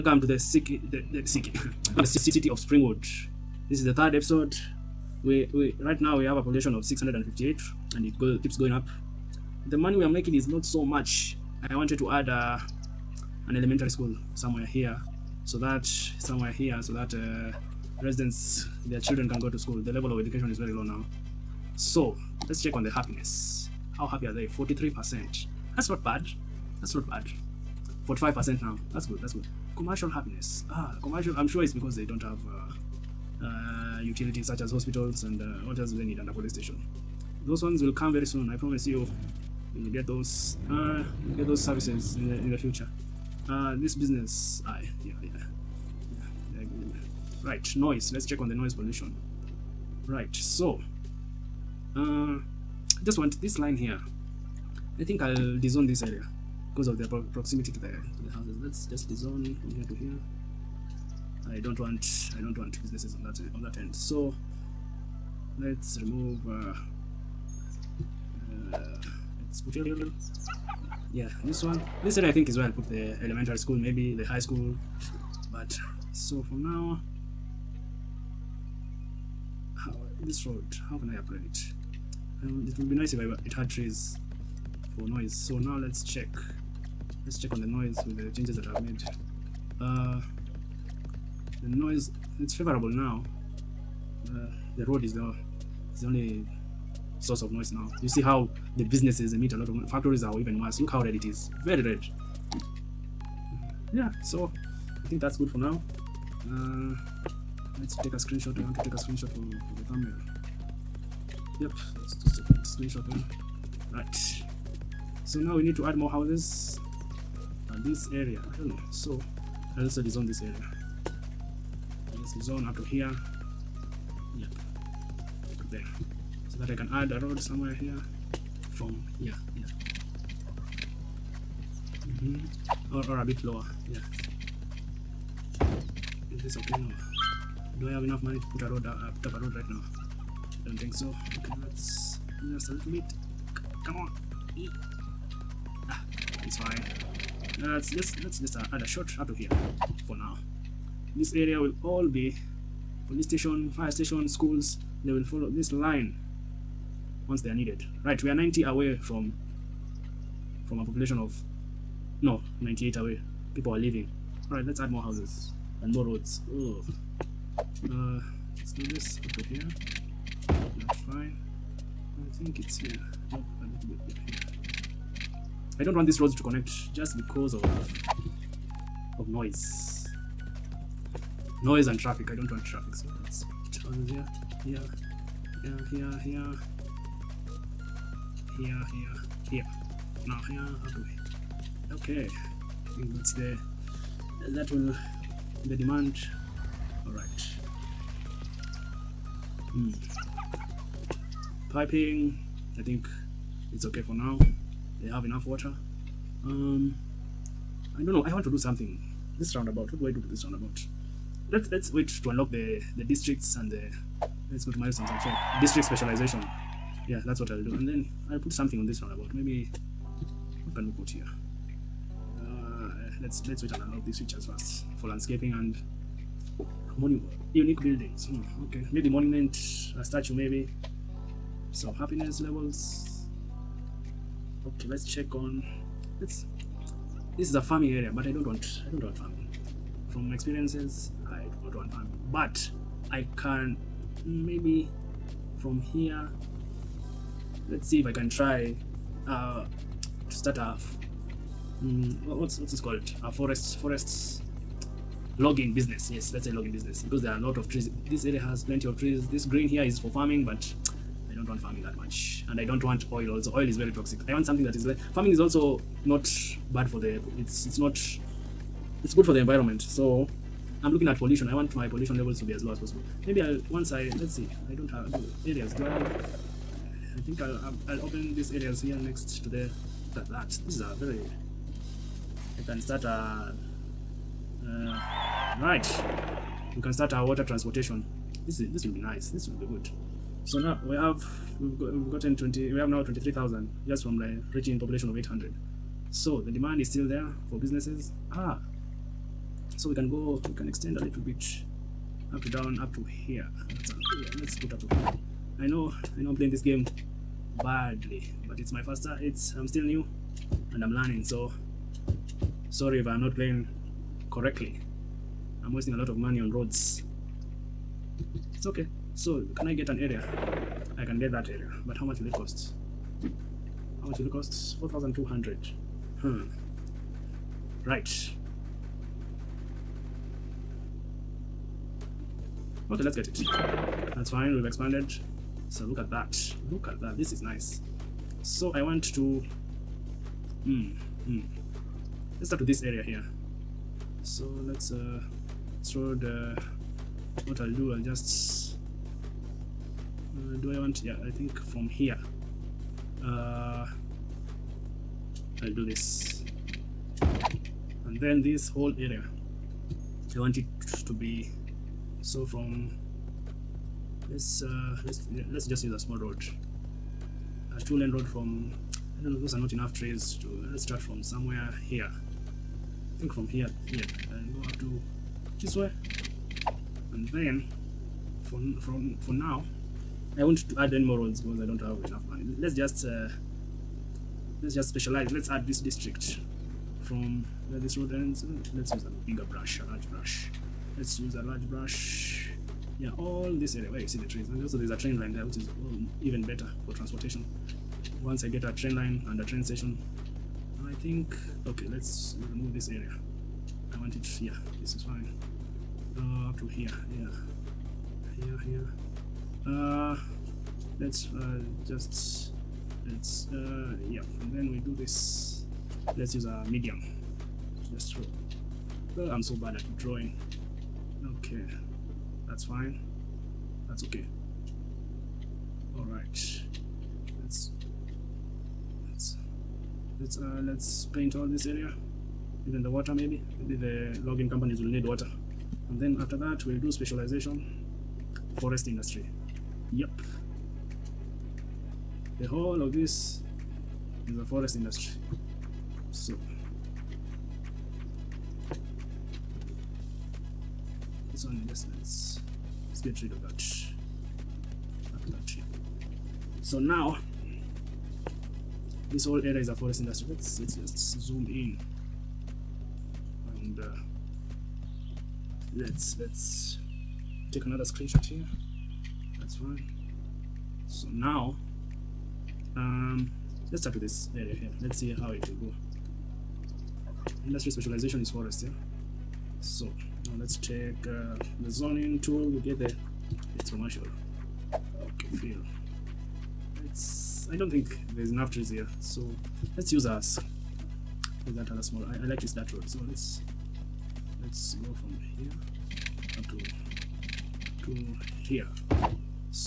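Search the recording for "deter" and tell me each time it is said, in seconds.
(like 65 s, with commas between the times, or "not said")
not said.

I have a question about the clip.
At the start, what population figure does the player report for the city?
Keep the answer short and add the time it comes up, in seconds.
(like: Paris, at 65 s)
658, at 6 s.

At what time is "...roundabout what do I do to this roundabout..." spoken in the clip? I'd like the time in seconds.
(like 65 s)
209 s.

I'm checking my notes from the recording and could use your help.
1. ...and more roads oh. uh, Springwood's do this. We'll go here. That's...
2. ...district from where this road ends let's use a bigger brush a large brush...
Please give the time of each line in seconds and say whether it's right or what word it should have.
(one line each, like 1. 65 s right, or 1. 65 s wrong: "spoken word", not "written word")
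1. 165 s wrong: "Let", not "Springwood"
2. 385 s right.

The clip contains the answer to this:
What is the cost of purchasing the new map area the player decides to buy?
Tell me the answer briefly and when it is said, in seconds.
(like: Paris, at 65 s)
4200, at 324 s.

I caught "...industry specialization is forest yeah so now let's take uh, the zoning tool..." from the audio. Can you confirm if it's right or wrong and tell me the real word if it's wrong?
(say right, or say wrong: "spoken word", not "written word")
right.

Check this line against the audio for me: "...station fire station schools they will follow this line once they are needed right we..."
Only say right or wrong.
right.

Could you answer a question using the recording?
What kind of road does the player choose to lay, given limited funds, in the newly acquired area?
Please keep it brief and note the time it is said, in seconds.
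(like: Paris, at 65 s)
Two lane road, at 367 s.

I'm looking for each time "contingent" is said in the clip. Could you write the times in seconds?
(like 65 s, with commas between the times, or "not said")
not said.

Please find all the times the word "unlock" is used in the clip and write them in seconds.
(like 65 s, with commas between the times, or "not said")
212 s, 223 s.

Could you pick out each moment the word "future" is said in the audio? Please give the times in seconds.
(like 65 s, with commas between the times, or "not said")
42 s.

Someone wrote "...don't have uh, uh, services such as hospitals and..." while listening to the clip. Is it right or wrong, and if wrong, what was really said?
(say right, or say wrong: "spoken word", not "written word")
wrong: "utilities", not "services".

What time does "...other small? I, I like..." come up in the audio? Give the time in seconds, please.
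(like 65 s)
491 s.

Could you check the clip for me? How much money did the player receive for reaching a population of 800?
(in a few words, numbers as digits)
23,000.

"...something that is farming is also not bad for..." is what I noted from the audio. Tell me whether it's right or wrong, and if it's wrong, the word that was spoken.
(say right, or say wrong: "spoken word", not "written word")
right.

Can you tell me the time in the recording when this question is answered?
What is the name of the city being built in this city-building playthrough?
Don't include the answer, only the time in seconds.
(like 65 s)
2 s.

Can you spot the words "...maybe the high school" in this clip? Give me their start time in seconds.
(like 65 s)
73 s.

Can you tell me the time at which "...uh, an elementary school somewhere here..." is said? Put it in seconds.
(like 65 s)
12 s.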